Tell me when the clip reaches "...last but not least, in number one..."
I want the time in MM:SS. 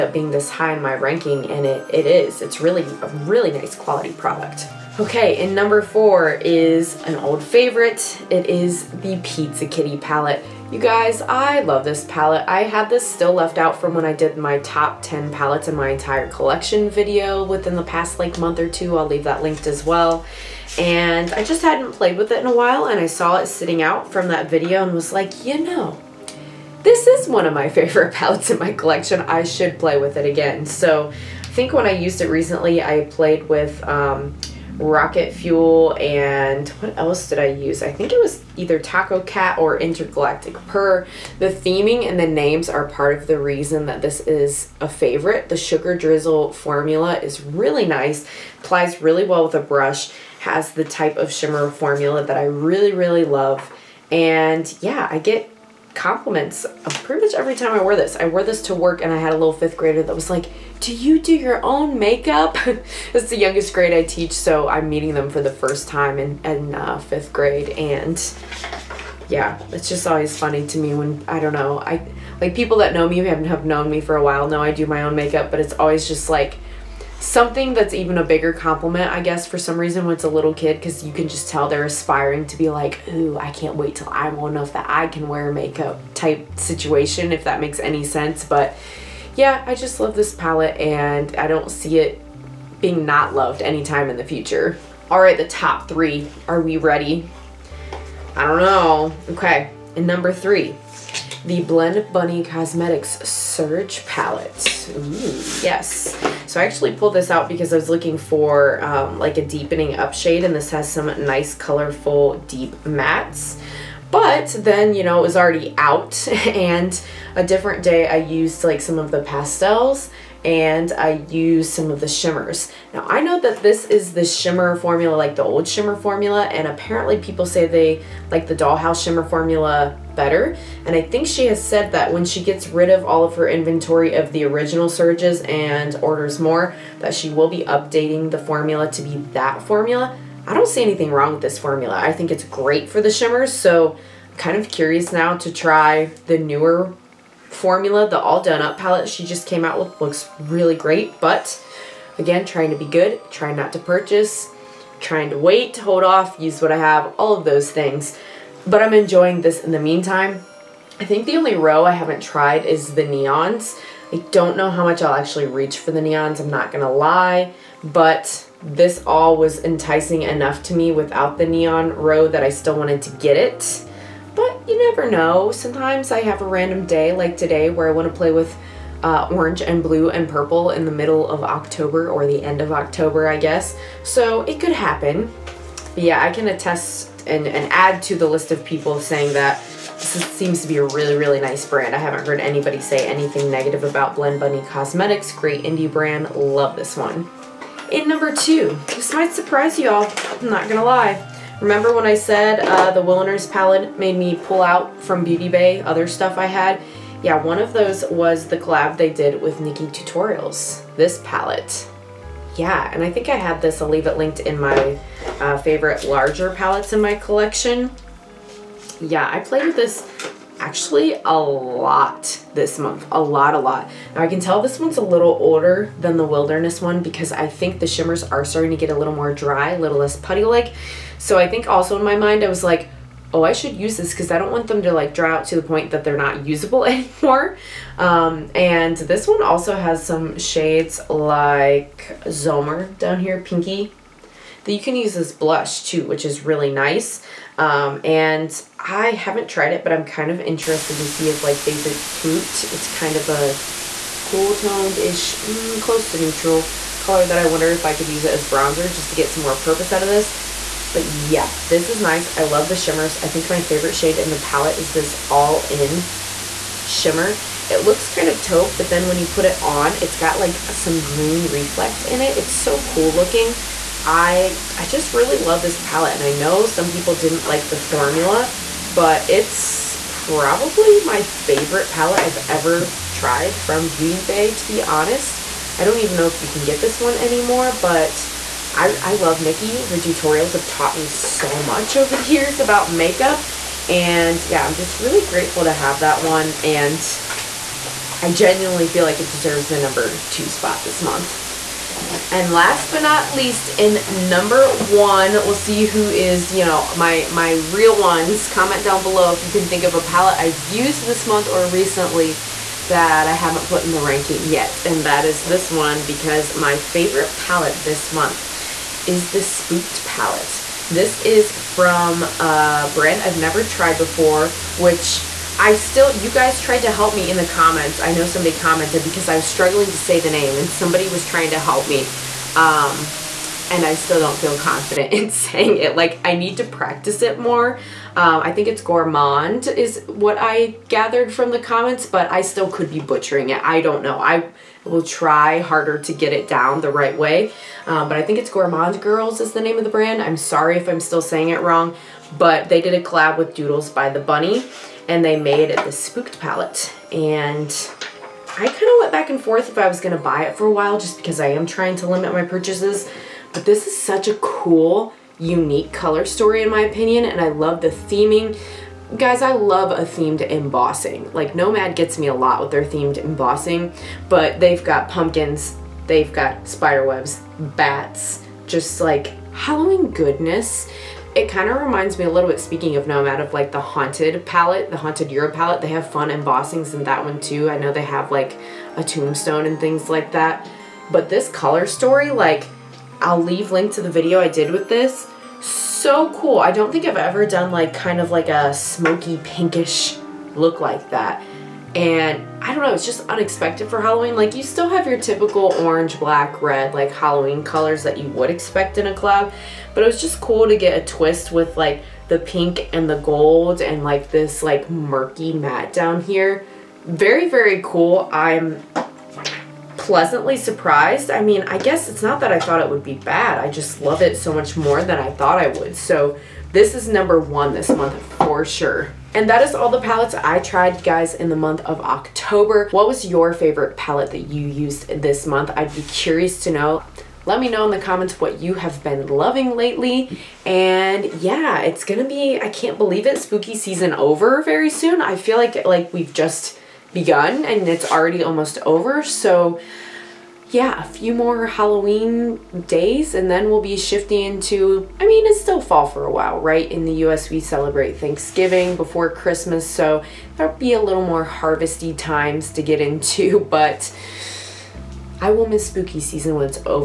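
05:02.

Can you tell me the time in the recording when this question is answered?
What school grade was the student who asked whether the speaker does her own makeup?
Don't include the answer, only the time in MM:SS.
00:59.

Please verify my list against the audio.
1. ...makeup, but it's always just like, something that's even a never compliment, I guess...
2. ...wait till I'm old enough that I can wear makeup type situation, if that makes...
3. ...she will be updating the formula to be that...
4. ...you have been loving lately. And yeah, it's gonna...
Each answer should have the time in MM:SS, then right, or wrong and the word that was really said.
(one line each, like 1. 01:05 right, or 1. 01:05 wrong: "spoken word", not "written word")
1. 01:15 wrong: "bigger", not "never"
2. 01:23 right
3. 02:17 right
4. 07:18 right.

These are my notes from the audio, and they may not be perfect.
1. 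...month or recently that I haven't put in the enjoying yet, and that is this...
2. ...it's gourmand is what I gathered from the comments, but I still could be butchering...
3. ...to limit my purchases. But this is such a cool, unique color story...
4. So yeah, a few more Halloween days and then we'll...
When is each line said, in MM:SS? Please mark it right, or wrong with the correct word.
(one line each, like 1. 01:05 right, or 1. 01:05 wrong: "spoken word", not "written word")
1. 05:11 wrong: "ranking", not "enjoying"
2. 05:38 right
3. 06:01 right
4. 07:29 right.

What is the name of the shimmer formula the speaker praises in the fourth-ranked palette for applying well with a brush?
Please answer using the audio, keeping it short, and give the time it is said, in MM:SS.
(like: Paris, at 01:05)
Sugar Drizzle, at 00:45.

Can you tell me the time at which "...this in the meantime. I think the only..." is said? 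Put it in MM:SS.
02:39.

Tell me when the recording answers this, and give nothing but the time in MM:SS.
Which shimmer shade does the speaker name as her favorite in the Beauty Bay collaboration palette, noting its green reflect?
04:25.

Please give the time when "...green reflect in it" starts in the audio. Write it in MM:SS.
04:31.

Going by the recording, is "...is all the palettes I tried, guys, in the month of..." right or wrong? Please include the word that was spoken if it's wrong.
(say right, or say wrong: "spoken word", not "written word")
right.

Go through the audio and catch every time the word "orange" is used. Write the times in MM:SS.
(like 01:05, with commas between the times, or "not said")
02:59, 06:45.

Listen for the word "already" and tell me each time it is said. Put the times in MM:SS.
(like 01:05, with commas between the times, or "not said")
01:55, 07:28.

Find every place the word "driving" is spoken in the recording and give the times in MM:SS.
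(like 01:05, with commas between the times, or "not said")
not said.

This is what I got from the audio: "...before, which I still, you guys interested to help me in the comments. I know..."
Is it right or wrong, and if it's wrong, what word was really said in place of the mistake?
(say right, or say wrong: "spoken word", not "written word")
wrong: "tried", not "interested".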